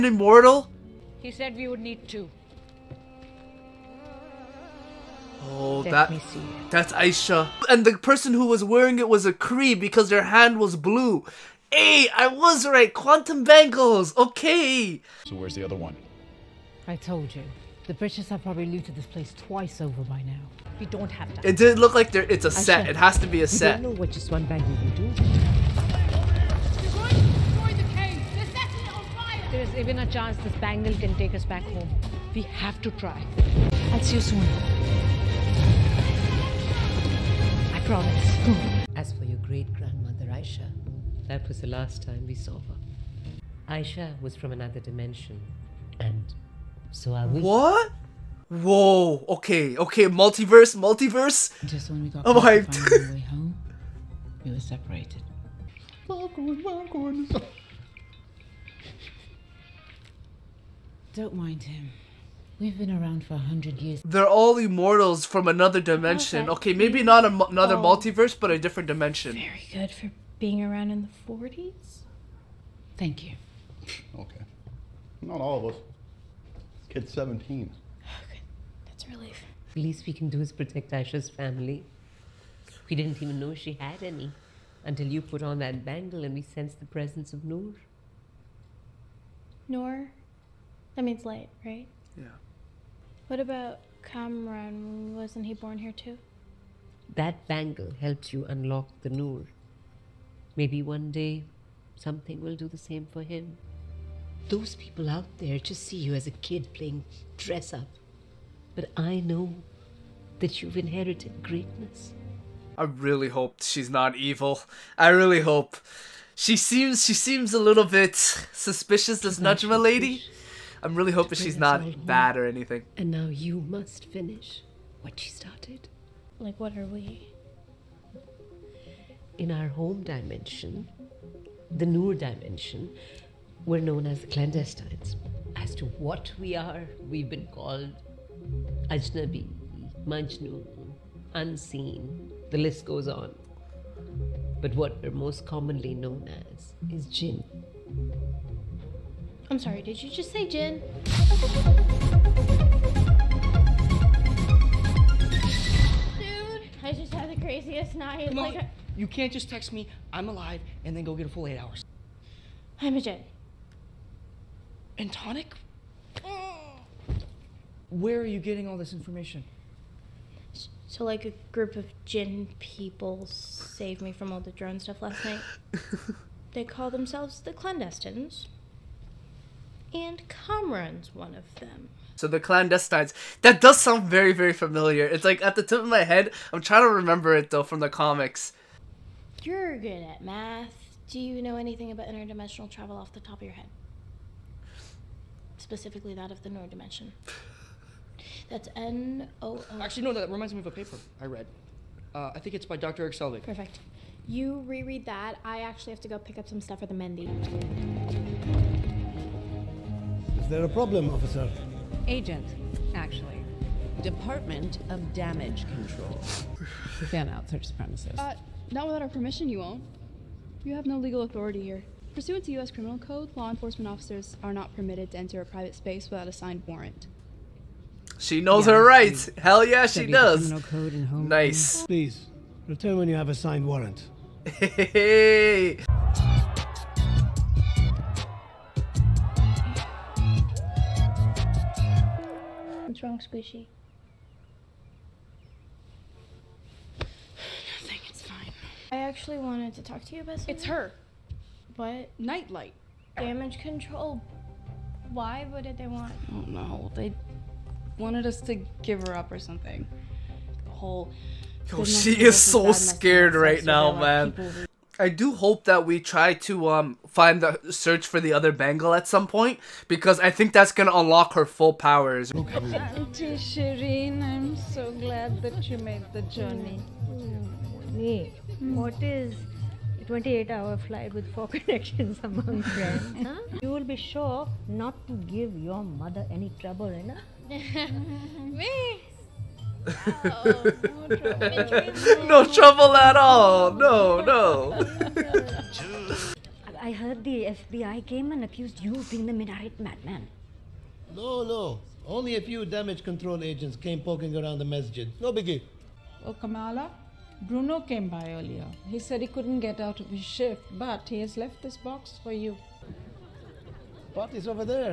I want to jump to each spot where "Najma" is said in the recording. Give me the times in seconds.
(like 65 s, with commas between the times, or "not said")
119 s.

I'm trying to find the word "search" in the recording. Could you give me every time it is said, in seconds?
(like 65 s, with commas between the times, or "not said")
217 s, 267 s.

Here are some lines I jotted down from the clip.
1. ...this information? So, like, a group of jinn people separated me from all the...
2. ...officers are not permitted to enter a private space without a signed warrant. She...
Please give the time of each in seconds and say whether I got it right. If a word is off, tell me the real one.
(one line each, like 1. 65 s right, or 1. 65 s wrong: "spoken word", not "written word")
1. 168 s wrong: "saved", not "separated"
2. 223 s right.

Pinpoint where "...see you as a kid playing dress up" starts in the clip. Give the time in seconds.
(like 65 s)
105 s.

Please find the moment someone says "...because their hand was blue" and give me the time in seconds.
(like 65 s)
9 s.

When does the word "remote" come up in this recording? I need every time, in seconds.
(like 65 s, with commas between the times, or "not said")
not said.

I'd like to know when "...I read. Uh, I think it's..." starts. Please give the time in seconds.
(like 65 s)
201 s.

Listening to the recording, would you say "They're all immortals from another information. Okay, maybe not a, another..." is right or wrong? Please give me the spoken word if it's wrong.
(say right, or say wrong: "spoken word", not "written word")
wrong: "dimension", not "information".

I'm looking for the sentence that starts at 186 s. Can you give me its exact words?
I'm trying to remember it though from the comics.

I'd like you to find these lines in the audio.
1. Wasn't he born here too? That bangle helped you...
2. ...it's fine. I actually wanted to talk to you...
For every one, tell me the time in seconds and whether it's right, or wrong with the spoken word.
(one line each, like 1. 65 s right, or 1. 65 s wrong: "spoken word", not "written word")
1. 95 s right
2. 248 s right.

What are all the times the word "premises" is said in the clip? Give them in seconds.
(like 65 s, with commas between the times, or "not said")
217 s.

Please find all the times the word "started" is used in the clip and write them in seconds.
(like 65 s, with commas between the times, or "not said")
125 s.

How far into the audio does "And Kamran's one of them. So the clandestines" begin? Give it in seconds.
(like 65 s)
179 s.